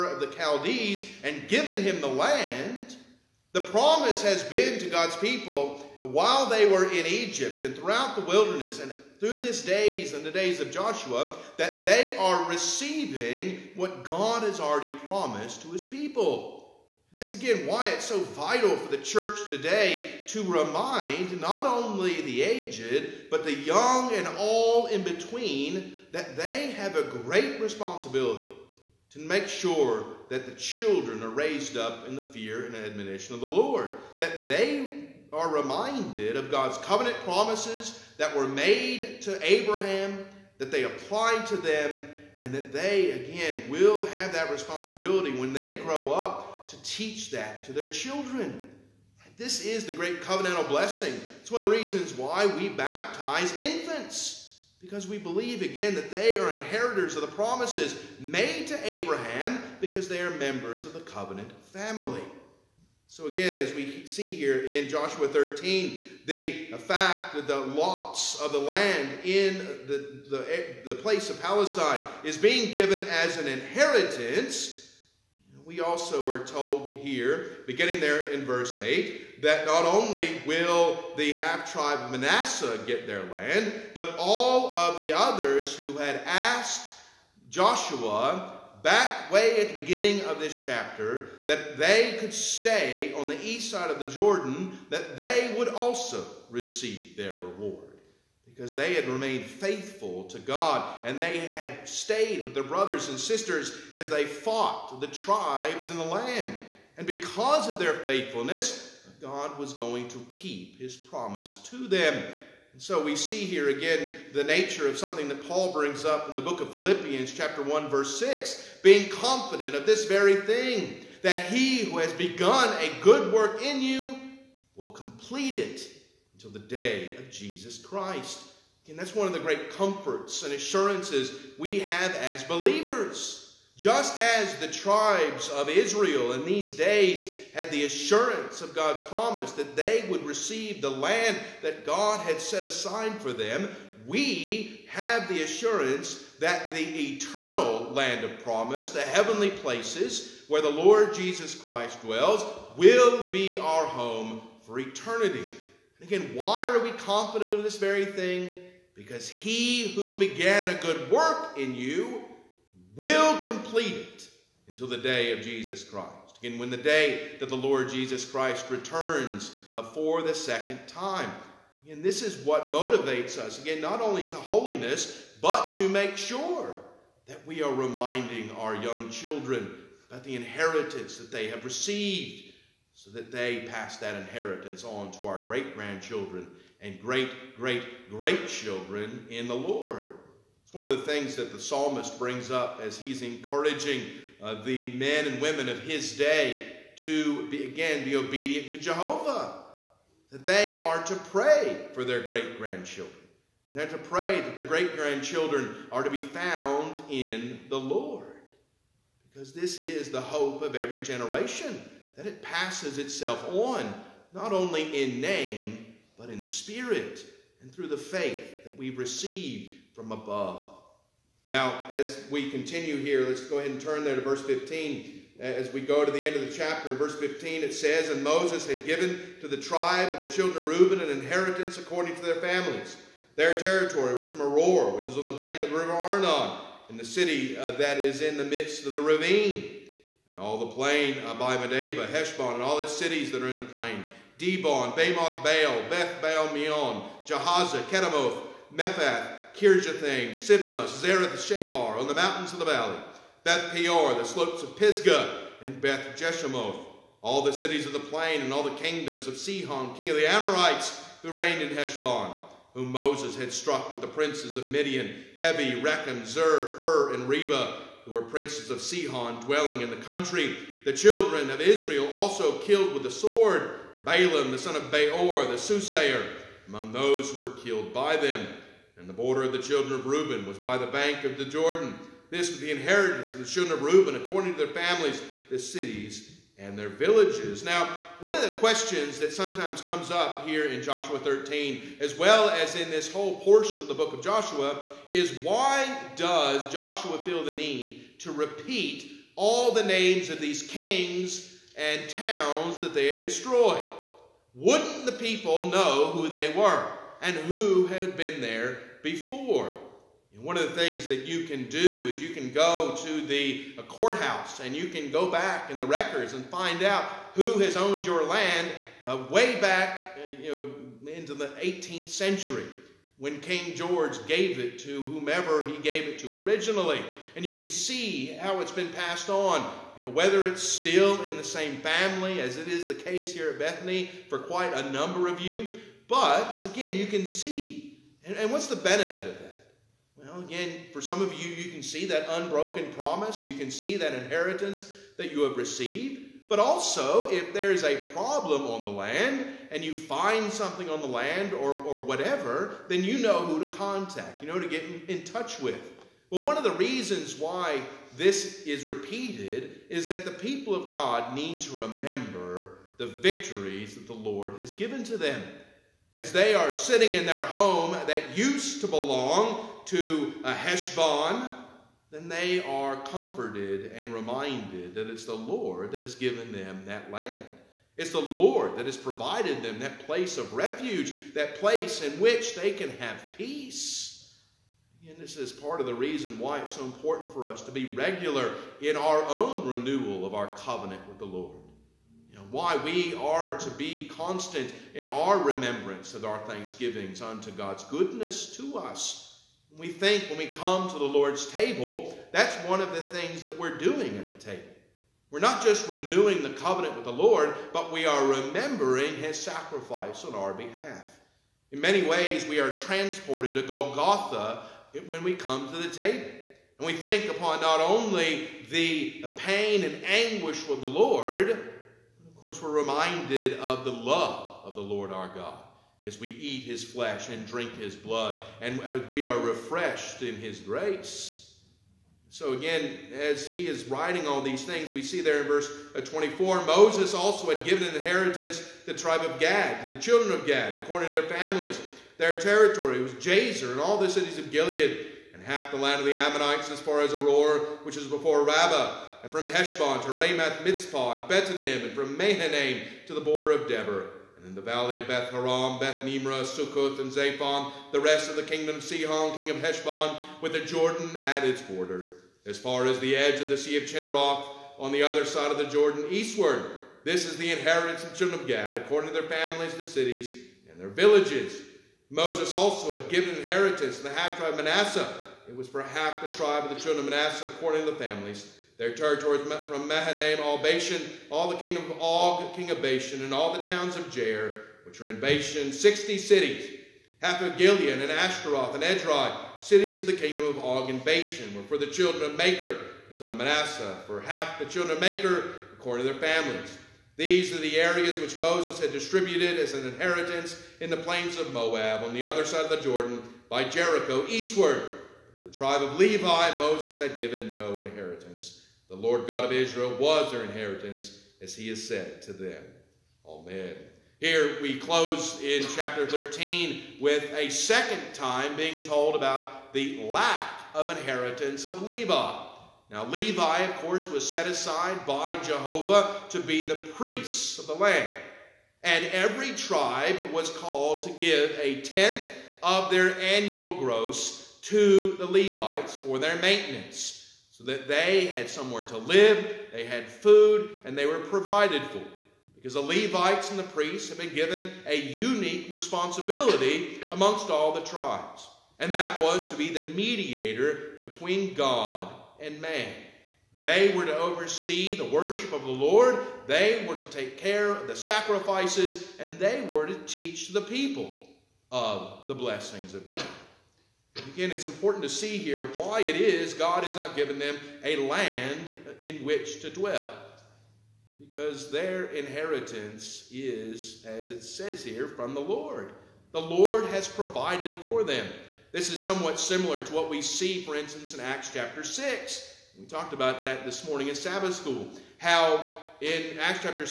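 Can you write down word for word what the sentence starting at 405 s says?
We're not just renewing the covenant with the Lord, but we are remembering his sacrifice on our behalf.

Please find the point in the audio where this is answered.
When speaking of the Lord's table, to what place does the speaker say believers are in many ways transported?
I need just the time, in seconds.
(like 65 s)
413 s.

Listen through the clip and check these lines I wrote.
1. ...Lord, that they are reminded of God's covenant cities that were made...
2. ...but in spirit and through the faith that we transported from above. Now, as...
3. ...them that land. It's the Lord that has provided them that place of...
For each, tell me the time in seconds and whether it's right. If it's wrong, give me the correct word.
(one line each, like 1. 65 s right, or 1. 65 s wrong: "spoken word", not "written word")
1. 33 s wrong: "promises", not "cities"
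2. 216 s wrong: "received", not "transported"
3. 376 s right.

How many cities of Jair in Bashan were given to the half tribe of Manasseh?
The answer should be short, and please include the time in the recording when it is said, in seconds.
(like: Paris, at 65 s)
60, at 485 s.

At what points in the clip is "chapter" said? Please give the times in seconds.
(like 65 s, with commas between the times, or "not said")
90 s, 117 s, 226 s, 515 s, 581 s.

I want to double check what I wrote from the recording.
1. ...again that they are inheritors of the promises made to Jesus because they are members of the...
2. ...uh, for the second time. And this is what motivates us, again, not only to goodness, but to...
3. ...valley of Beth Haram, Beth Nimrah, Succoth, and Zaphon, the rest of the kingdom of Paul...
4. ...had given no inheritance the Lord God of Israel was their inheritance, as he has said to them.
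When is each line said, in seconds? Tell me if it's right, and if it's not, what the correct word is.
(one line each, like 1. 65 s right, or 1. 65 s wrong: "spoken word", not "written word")
1. 55 s wrong: "Abraham", not "Jesus"
2. 169 s wrong: "holiness", not "goodness"
3. 454 s wrong: "Sihon", not "Paul"
4. 506 s right.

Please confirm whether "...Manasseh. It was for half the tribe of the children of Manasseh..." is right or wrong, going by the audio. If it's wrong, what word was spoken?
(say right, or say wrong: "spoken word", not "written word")
right.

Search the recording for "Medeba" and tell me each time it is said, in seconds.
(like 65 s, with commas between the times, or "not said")
241 s.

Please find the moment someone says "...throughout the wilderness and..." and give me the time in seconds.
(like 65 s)
7 s.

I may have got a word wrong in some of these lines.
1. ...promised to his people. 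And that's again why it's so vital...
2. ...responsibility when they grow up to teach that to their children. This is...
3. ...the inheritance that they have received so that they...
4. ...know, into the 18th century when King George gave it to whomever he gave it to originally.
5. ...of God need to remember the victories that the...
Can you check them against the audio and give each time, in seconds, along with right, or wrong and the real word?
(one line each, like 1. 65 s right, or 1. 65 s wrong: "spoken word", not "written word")
1. 15 s right
2. 44 s right
3. 180 s right
4. 321 s right
5. 360 s right.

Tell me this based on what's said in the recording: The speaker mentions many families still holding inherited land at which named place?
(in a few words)
Bethany.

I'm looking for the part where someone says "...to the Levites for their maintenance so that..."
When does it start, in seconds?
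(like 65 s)
534 s.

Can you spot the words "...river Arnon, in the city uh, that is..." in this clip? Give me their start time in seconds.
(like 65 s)
235 s.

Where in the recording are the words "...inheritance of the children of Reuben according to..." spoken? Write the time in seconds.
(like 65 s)
282 s.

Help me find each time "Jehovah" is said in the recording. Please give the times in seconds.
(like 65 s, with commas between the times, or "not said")
198 s, 525 s.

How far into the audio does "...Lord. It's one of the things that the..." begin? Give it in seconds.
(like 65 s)
189 s.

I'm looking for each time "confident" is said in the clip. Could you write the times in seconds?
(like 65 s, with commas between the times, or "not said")
119 s, 156 s.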